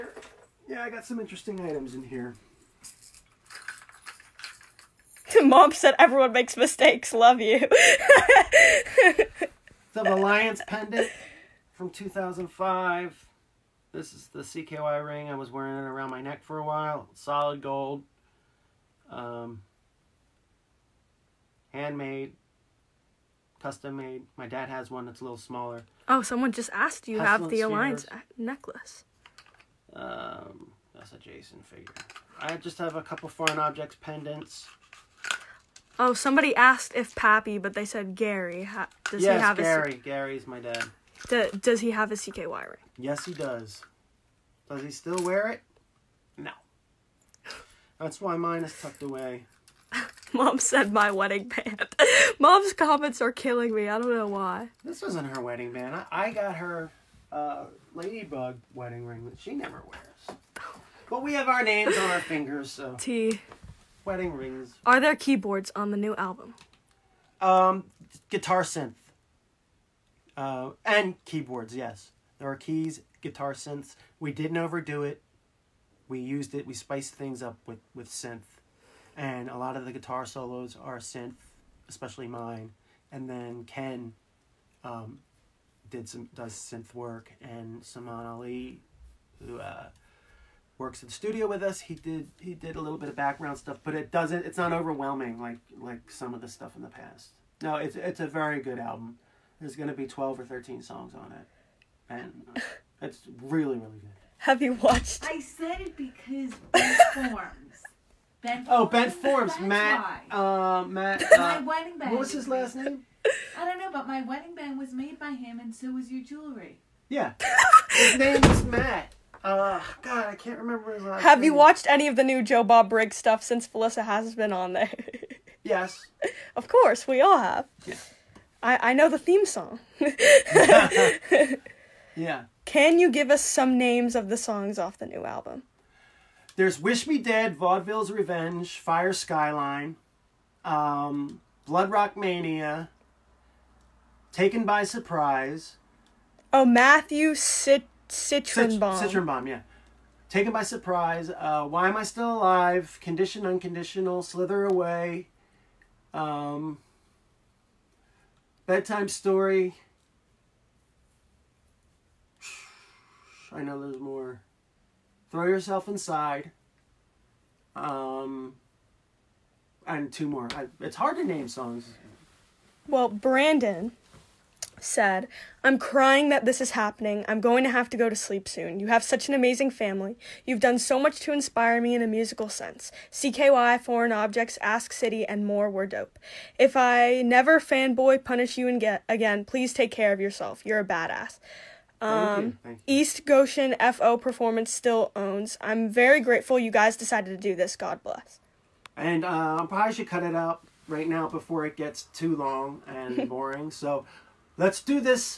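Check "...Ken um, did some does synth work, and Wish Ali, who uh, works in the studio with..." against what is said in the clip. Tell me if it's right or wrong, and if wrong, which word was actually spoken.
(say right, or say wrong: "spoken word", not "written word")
wrong: "Saman", not "Wish".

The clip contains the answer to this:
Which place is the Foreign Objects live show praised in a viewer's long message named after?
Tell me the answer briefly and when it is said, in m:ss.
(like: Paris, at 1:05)
East Goshen, at 3:12.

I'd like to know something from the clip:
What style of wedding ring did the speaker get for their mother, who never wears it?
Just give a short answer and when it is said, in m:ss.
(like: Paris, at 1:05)
Ladybug, at 0:57.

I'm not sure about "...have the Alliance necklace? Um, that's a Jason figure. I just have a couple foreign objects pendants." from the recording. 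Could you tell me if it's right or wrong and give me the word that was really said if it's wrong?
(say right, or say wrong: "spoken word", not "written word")
right.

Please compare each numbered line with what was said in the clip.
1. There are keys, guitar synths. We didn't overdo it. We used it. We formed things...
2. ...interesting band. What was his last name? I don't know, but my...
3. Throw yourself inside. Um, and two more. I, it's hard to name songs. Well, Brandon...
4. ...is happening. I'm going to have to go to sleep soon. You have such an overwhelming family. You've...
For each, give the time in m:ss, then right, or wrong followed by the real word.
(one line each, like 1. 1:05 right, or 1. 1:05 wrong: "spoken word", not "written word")
1. 1:12 wrong: "spiced", not "formed"
2. 1:51 wrong: "wedding", not "interesting"
3. 2:45 right
4. 2:56 wrong: "amazing", not "overwhelming".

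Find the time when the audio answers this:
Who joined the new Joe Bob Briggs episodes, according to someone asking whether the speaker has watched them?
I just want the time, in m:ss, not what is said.
2:03.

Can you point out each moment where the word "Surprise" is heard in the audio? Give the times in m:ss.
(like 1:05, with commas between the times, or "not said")
2:24, 2:30.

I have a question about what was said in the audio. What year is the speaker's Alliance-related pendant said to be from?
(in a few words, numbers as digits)
2005.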